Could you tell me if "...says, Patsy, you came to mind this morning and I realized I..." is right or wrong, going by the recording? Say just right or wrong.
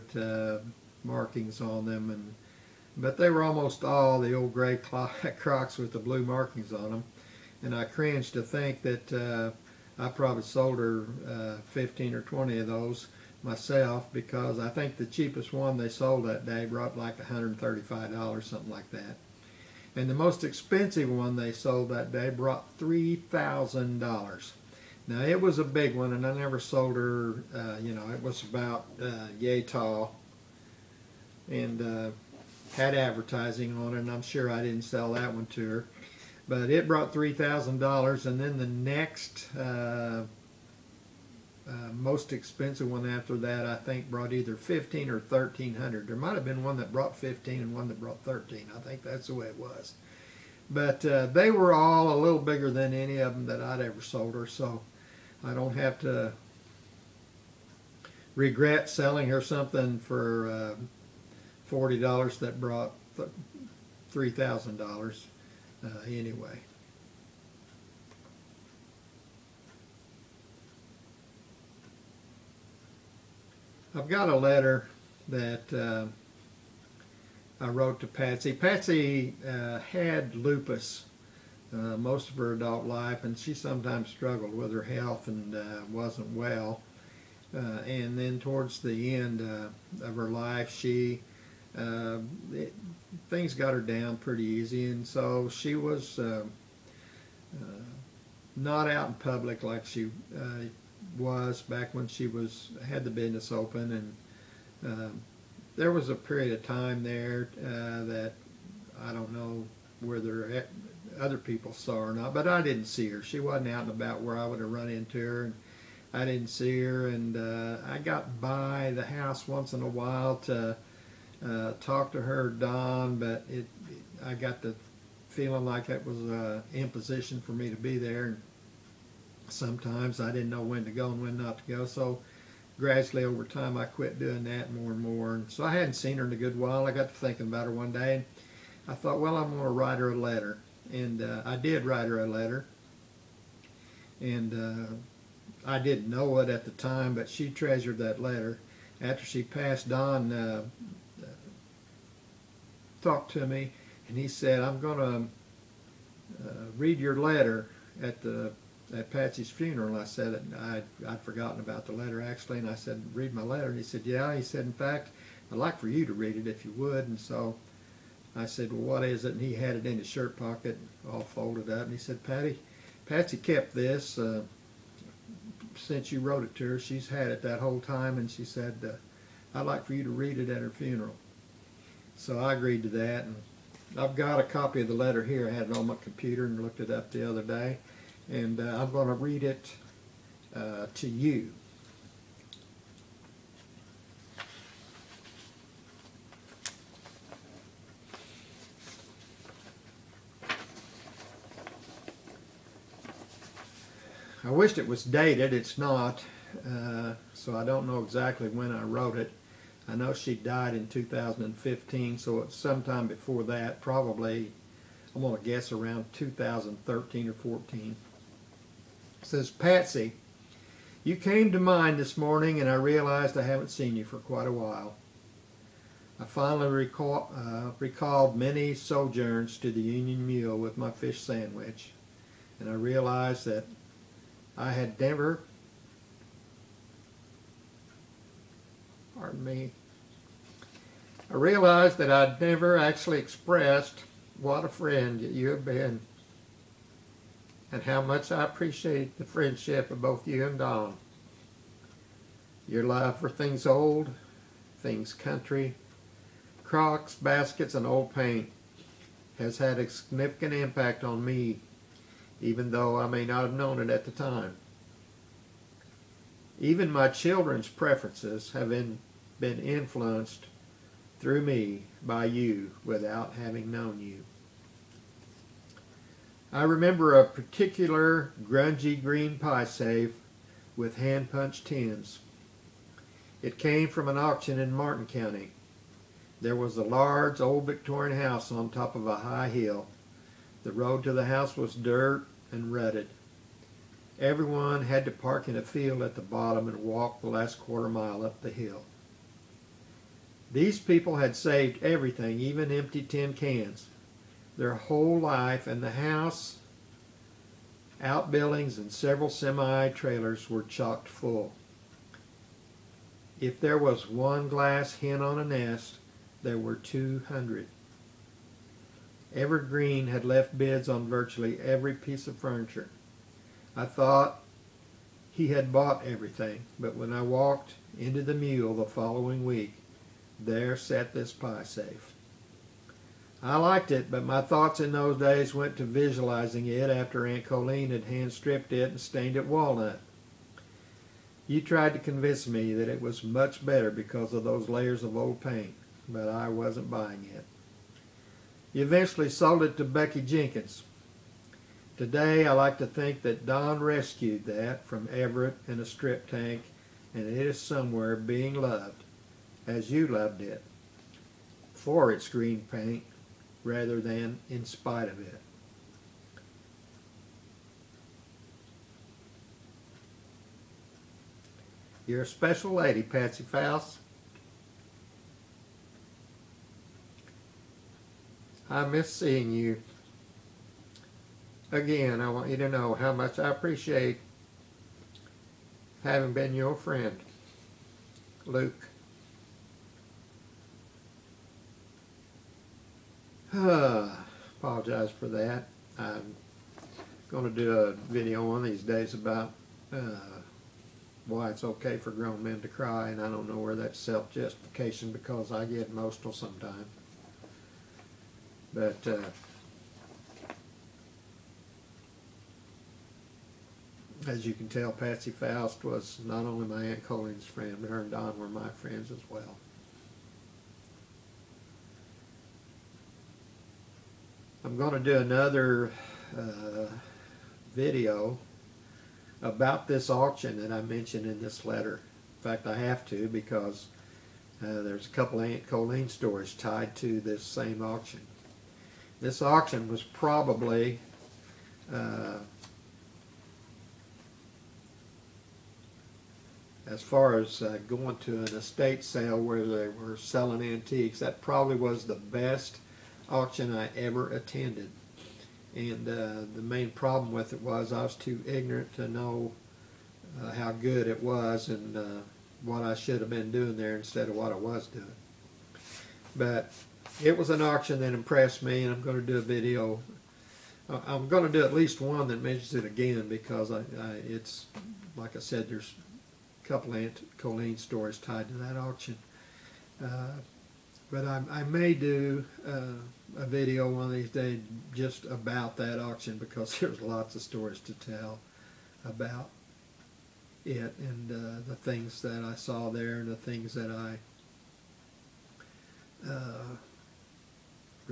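right.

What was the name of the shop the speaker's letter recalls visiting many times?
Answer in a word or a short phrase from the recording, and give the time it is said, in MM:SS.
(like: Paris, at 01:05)
Union Mule, at 03:49.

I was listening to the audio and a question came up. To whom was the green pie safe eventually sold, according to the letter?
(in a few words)
Becky Jenkins.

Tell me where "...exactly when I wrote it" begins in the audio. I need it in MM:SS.
03:28.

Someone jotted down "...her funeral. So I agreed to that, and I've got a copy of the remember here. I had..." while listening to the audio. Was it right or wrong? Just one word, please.
wrong.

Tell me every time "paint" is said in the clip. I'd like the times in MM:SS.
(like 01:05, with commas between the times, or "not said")
04:18, 05:45, 06:02.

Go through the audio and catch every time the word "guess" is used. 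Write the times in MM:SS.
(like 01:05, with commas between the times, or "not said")
03:35.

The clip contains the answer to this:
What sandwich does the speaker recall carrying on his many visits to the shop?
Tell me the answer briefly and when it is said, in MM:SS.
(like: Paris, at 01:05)
fish sandwich, at 03:50.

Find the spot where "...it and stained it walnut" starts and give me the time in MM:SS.
05:38.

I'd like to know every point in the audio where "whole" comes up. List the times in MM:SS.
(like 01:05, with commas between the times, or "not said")
02:57, 05:04.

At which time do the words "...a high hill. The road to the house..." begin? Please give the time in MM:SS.
04:49.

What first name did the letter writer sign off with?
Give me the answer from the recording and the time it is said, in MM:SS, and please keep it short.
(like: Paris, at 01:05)
Luke, at 06:28.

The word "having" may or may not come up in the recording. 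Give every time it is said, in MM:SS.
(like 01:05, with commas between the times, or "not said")
04:33, 06:26.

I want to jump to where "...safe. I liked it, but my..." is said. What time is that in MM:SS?
05:31.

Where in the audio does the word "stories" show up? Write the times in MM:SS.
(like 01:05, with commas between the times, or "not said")
07:16, 07:57, 08:07.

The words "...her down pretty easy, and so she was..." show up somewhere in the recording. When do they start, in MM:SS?
01:33.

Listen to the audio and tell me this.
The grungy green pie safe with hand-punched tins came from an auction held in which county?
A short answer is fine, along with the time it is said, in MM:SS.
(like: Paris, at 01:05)
Martin County, at 04:44.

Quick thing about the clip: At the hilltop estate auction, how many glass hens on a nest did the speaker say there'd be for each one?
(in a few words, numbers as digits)
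200.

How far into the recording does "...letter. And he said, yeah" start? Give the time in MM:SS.
02:43.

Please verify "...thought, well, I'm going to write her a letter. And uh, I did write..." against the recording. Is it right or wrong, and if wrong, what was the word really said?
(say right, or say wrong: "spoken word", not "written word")
right.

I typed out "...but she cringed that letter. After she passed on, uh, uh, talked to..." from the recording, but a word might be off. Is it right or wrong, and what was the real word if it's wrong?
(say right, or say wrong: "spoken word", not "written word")
wrong: "treasured", not "cringed".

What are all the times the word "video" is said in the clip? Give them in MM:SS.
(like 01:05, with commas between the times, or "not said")
06:37, 07:07, 07:49, 08:03.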